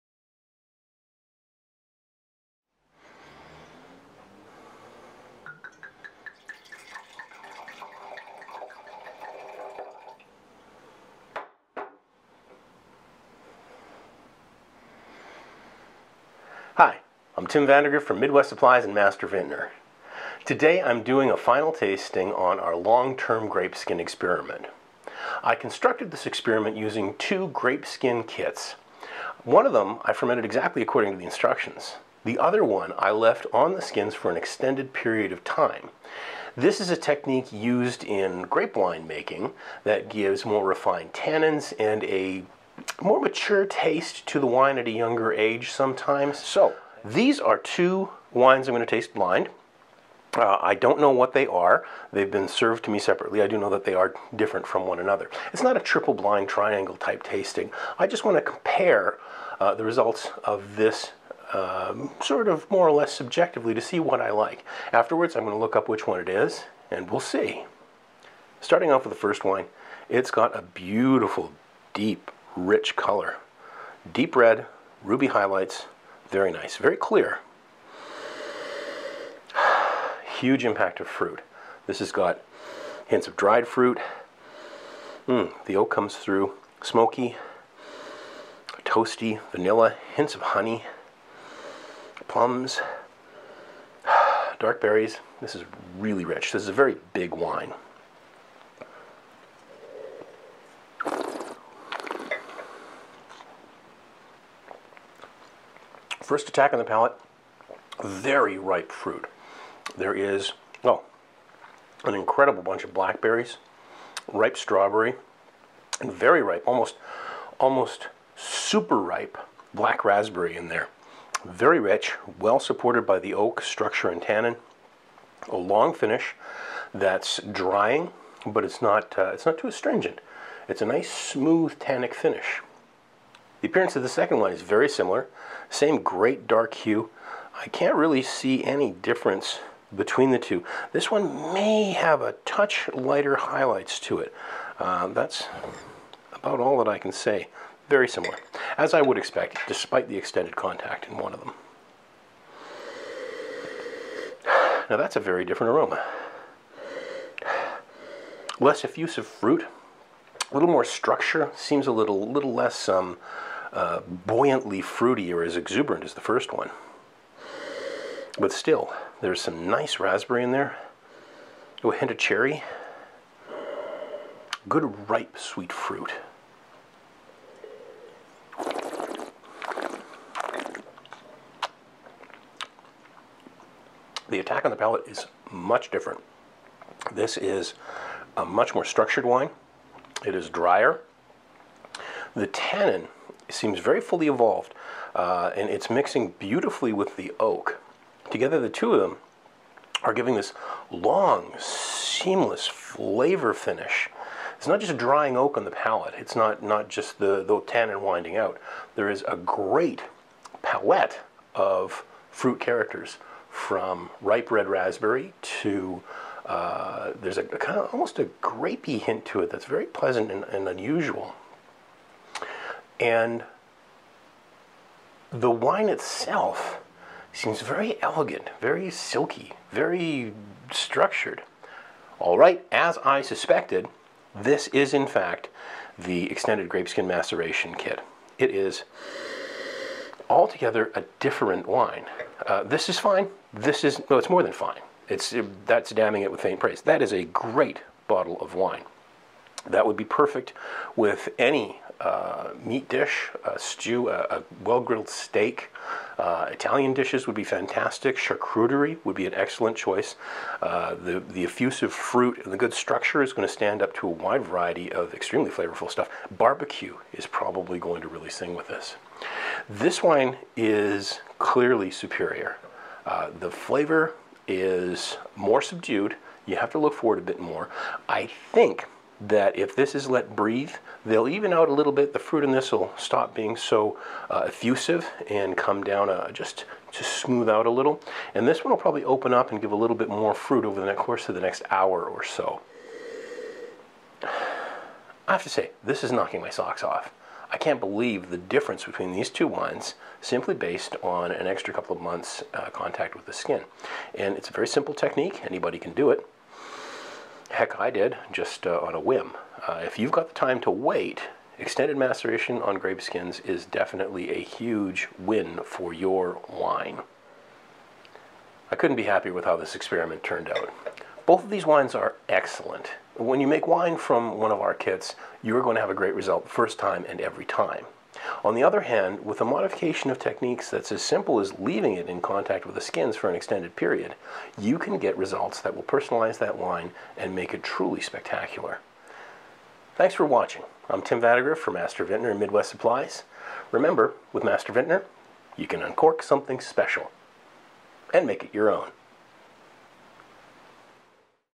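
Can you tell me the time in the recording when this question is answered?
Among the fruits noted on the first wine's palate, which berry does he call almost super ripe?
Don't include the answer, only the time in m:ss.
1:59.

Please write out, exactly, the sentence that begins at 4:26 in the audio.
Barbecue is probably going to really sing with this.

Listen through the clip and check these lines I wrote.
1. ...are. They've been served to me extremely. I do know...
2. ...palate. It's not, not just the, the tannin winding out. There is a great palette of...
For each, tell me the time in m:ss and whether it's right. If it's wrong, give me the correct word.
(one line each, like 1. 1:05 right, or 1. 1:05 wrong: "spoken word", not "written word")
1. 0:51 wrong: "separately", not "extremely"
2. 3:25 right.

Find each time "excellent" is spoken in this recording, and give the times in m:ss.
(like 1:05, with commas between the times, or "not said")
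4:19, 5:22.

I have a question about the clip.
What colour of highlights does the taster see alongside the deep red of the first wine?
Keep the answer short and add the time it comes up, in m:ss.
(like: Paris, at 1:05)
ruby, at 1:15.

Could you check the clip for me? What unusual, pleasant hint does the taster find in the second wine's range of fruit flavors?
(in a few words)
grapey.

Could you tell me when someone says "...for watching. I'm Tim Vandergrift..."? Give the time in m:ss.
5:40.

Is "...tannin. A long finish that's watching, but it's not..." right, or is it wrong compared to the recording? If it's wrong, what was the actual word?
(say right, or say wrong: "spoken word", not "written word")
wrong: "drying", not "watching".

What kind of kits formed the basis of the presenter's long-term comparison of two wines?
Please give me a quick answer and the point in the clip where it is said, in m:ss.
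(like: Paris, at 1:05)
grape skin kits, at 0:27.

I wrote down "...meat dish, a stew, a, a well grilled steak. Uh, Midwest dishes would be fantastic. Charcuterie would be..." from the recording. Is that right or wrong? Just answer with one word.
wrong.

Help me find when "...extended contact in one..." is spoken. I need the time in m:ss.
2:30.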